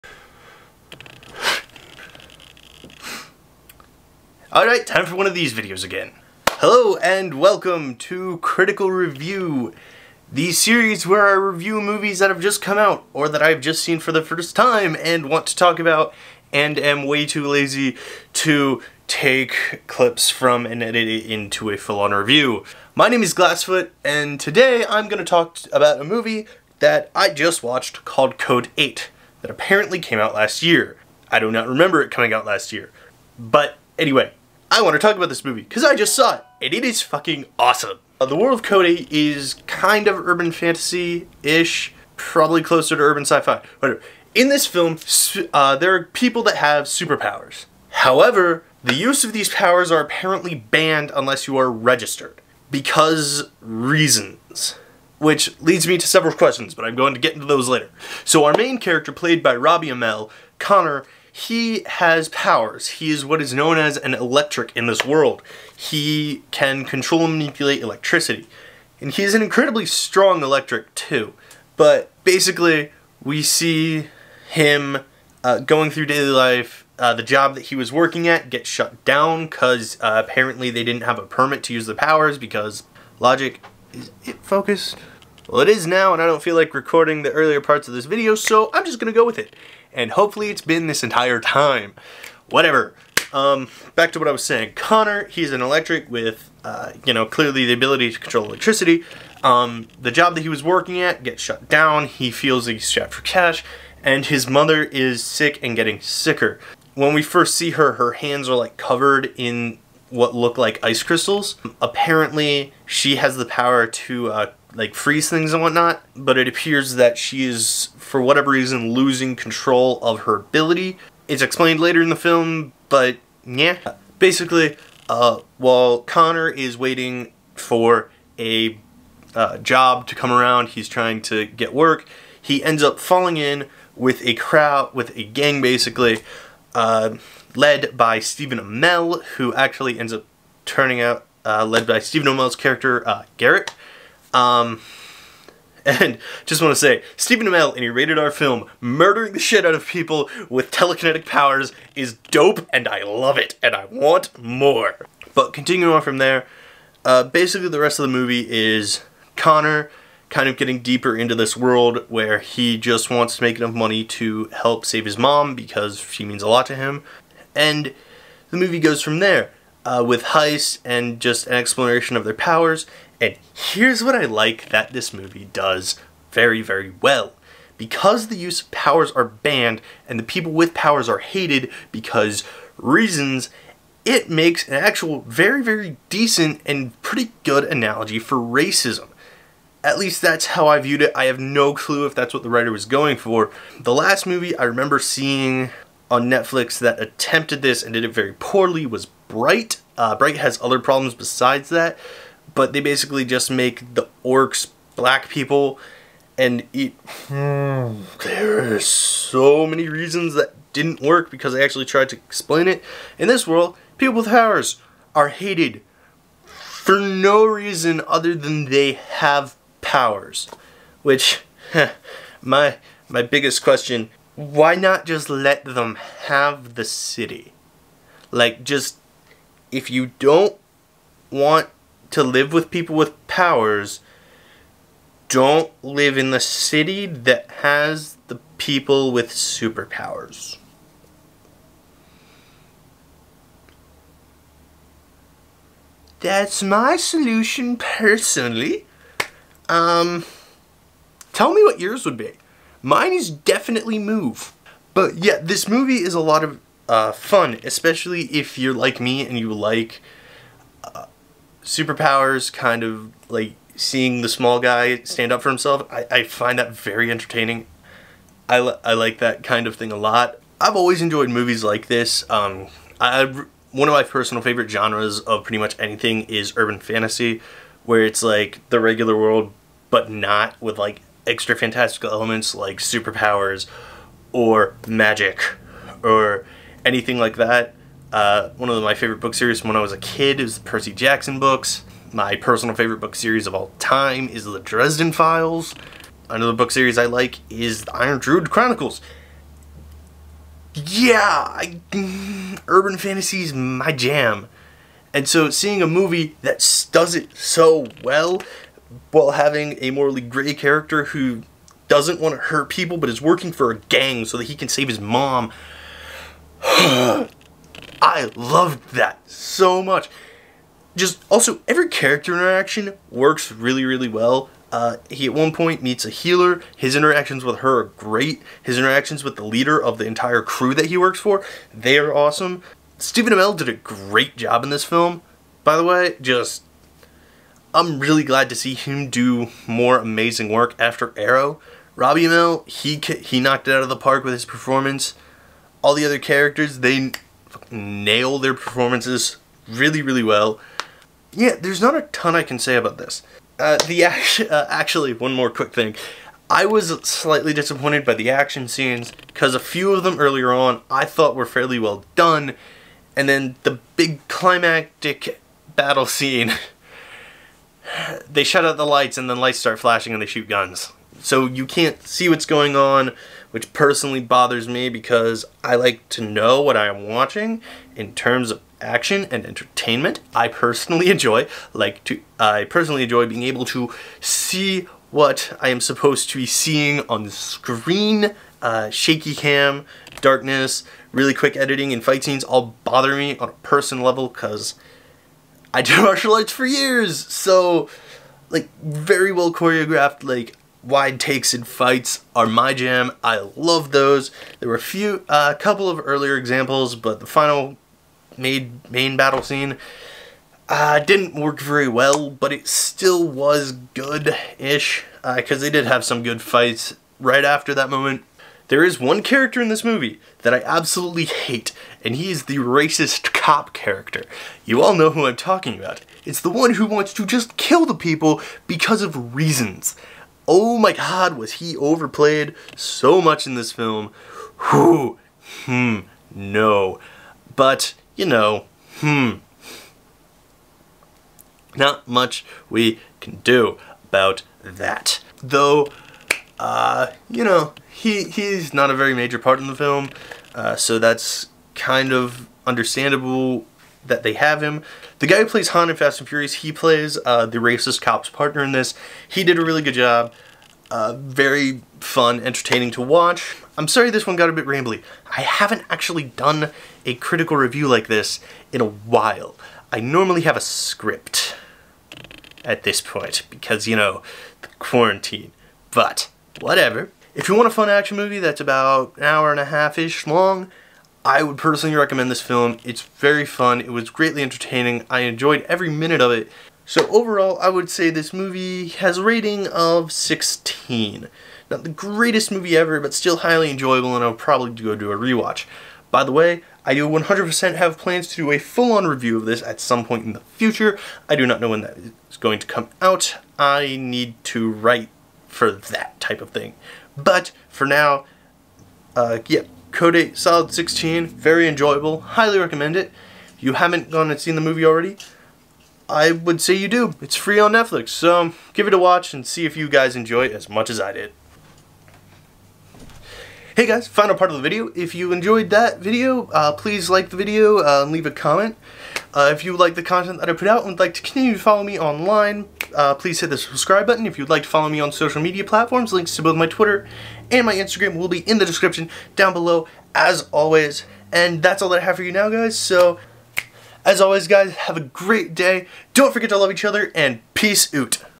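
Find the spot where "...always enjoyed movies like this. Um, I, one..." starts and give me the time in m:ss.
4:30.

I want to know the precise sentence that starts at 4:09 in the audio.
Um, tell me what yours would be.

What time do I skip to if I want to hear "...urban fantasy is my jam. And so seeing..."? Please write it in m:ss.
5:02.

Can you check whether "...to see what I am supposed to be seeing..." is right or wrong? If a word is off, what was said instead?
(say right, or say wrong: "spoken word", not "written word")
right.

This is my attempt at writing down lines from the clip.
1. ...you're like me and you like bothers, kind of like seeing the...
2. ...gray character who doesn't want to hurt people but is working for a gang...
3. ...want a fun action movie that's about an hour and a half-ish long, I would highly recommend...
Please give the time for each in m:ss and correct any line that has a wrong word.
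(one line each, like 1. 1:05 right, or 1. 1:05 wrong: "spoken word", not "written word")
1. 4:18 wrong: "superpowers", not "bothers"
2. 5:10 right
3. 7:57 wrong: "personally", not "highly".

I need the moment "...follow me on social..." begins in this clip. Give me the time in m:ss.
8:54.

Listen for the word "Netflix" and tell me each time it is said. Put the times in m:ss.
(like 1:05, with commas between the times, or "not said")
3:16, 8:37.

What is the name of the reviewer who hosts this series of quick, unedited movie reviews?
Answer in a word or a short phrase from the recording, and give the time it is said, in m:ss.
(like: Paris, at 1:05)
Glassfoot, at 0:23.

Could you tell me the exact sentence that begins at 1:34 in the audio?
Connor, he's an electric with, uh, you know, clearly the ability to control electricity.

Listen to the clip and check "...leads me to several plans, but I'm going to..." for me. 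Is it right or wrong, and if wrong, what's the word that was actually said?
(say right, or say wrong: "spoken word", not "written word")
wrong: "questions", not "plans".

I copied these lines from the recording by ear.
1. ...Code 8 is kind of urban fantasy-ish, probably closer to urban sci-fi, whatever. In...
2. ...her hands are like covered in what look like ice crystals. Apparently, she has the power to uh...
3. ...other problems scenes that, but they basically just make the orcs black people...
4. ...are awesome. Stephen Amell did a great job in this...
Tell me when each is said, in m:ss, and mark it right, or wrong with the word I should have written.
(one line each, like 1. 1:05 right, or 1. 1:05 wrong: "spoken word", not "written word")
1. 0:38 right
2. 1:47 right
3. 3:20 wrong: "besides", not "scenes"
4. 5:31 right.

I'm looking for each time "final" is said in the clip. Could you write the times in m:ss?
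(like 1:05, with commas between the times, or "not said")
6:47, 8:44.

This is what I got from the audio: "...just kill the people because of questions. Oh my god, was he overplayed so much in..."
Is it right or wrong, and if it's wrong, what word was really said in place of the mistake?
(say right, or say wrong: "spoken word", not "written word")
wrong: "reasons", not "questions".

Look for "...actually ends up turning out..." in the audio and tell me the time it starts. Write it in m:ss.
2:19.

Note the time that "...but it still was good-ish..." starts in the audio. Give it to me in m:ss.
6:52.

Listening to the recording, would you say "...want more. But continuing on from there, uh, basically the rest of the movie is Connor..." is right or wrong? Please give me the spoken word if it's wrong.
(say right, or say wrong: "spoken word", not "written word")
right.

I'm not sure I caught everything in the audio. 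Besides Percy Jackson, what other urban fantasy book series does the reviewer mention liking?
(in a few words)
The Iron Druid Chronicles.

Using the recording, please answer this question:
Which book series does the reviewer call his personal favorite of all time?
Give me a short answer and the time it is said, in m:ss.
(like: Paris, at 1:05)
The Dresden Files, at 4:54.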